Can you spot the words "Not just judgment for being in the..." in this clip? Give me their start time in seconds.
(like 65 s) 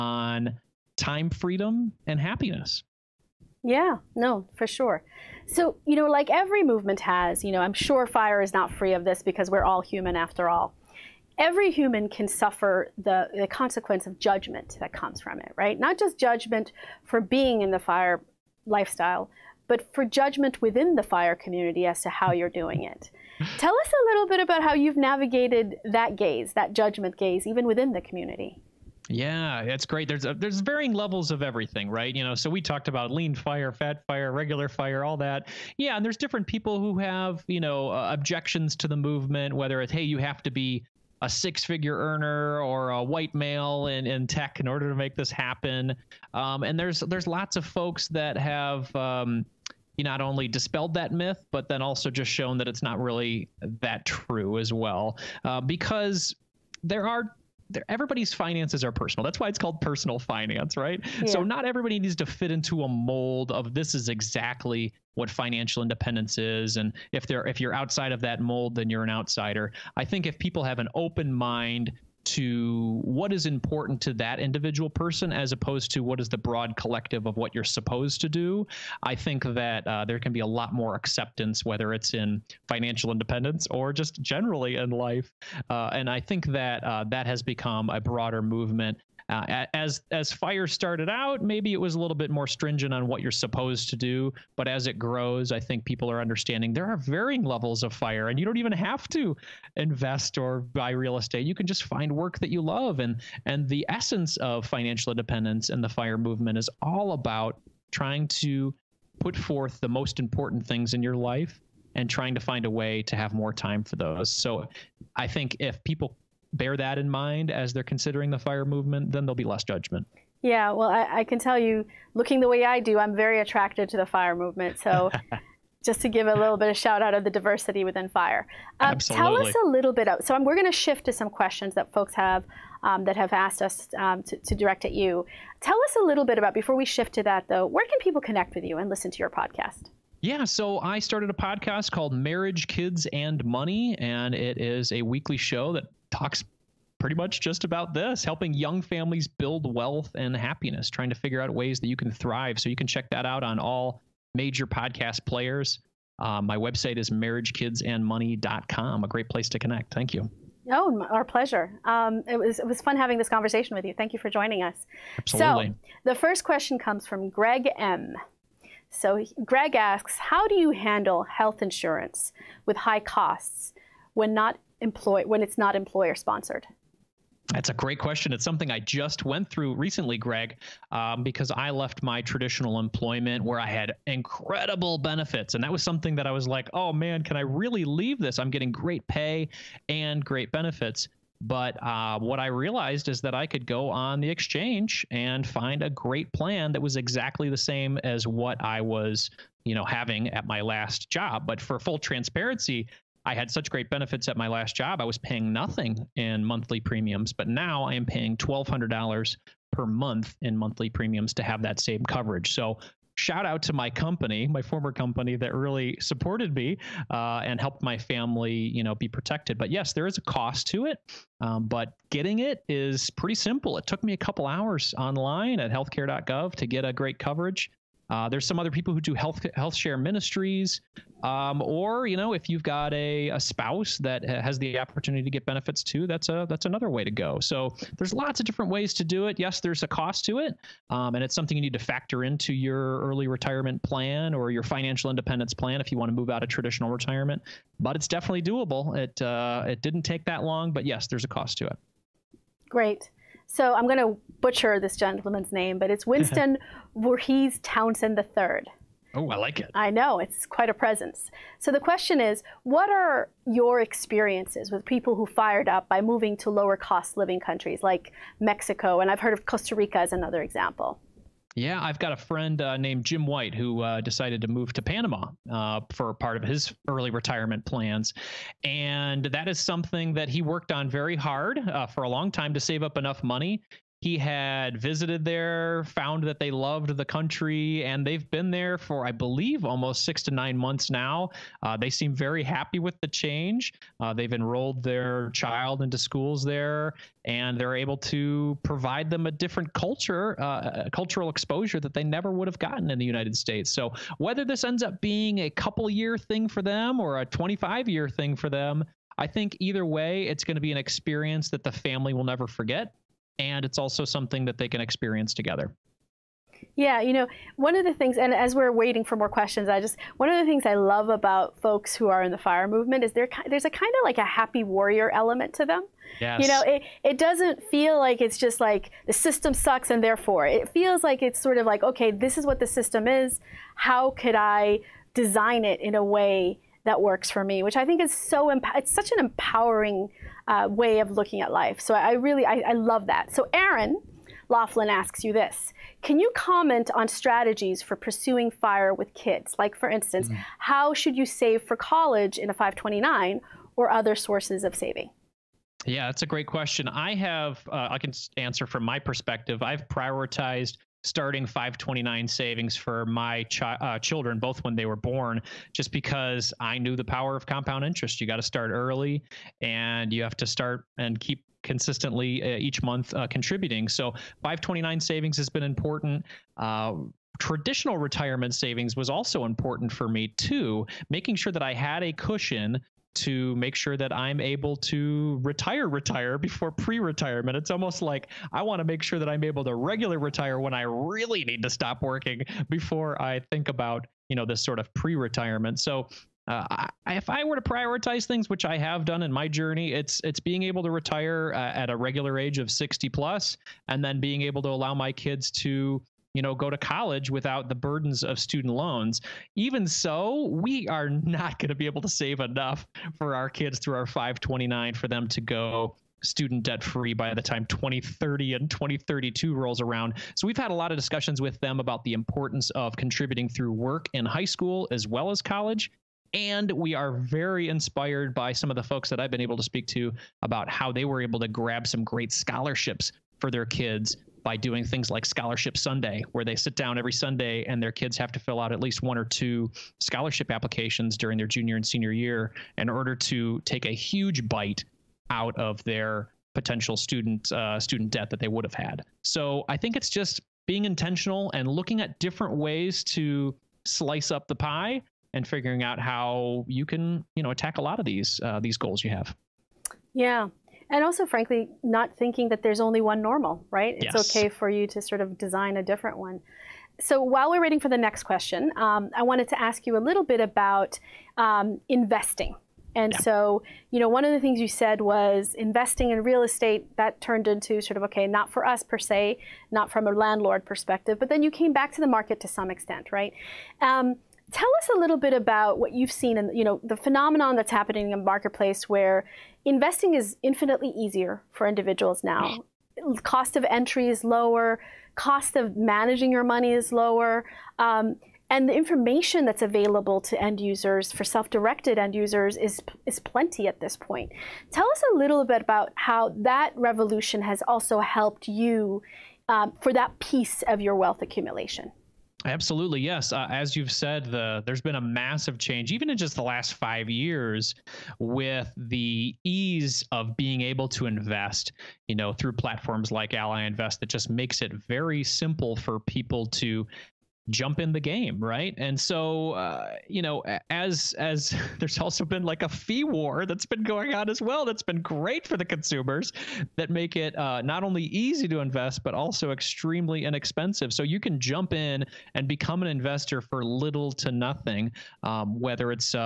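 15 s.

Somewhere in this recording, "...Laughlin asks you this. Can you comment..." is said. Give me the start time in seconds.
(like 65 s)
344 s.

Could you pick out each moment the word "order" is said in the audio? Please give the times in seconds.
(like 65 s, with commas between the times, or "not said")
44 s, 442 s.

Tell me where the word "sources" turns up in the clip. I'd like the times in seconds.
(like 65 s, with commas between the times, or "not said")
354 s.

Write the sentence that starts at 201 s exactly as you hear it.
But for full transparency, I had such great benefits at my last job.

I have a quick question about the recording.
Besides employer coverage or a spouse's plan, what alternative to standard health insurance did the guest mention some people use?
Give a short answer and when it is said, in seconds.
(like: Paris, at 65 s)
health share ministries, at 229 s.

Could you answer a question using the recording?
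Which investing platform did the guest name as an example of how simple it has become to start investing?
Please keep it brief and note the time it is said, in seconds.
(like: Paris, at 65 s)
Ally Invest, at 523 s.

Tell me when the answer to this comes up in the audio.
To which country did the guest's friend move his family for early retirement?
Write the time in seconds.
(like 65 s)
274 s.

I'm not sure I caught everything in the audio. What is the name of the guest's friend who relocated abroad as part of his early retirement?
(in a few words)
Jim White.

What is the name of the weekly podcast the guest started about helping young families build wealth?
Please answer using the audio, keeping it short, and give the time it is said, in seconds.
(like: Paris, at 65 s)
Marriage, Kids, and Money, at 142 s.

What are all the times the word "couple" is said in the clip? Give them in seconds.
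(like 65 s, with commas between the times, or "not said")
224 s, 305 s.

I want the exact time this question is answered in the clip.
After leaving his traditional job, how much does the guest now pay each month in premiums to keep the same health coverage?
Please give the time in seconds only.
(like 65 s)
208 s.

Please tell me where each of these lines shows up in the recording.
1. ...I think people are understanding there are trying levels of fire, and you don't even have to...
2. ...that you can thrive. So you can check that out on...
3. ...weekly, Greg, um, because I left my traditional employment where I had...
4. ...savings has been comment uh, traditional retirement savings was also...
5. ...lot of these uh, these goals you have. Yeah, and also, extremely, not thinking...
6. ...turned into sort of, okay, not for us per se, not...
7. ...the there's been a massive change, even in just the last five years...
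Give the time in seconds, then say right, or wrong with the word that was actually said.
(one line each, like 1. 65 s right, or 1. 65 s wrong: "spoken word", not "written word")
1. 95 s wrong: "varying", not "trying"
2. 151 s right
3. 179 s wrong: "recently", not "weekly"
4. 374 s wrong: "important", not "comment"
5. 457 s wrong: "frankly", not "extremely"
6. 477 s right
7. 514 s right.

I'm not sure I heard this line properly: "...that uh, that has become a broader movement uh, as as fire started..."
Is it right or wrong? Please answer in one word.
right.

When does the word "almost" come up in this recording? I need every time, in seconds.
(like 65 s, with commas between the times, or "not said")
289 s, 387 s.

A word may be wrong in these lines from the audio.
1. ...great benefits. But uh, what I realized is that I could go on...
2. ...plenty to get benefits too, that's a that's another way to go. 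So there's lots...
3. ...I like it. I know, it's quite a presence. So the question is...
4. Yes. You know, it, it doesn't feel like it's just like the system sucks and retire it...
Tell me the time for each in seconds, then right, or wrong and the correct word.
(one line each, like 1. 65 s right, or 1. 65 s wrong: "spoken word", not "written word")
1. 190 s right
2. 234 s wrong: "opportunity", not "plenty"
3. 259 s right
4. 326 s wrong: "therefore", not "retire".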